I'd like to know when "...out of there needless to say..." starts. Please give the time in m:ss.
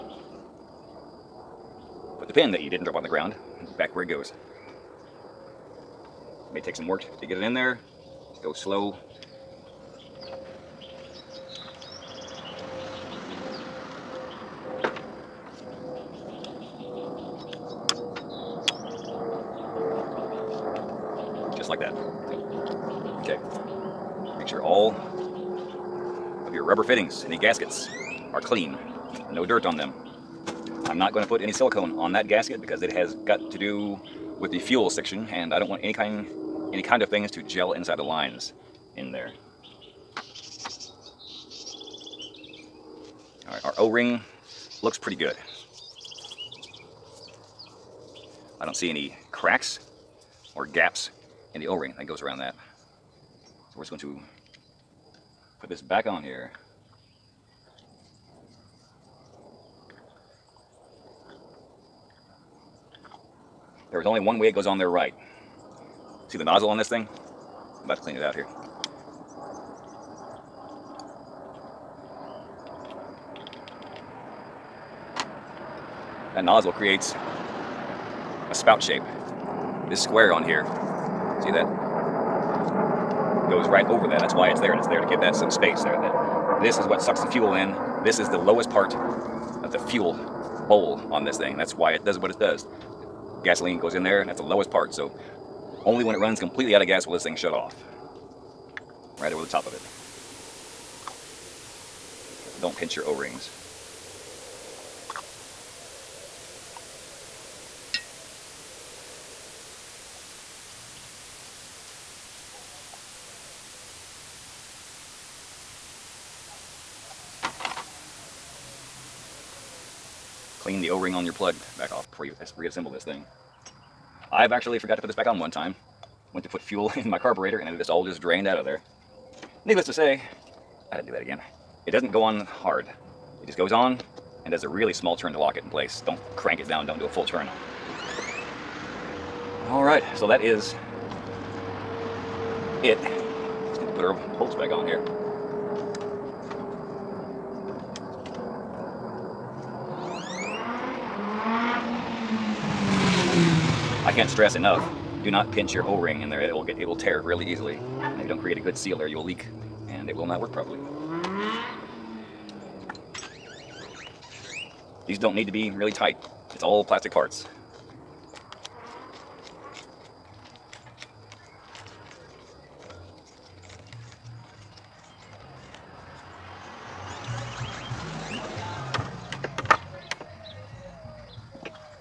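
2:08.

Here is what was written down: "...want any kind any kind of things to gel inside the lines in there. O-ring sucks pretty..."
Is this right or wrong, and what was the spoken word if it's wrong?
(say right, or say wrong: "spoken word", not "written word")
wrong: "looks", not "sucks".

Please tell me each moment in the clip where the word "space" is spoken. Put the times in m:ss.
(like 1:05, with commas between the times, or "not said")
1:25.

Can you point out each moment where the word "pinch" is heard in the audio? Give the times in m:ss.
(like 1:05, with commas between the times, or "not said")
1:42, 2:35.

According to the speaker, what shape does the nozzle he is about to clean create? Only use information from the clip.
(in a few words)
A spout shape.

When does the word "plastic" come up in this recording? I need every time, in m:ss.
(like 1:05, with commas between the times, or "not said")
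2:46.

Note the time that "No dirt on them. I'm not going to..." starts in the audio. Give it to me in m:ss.
0:29.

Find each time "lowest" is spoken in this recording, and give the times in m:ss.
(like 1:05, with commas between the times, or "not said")
1:28, 1:34.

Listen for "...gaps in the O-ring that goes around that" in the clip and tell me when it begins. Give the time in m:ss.
0:50.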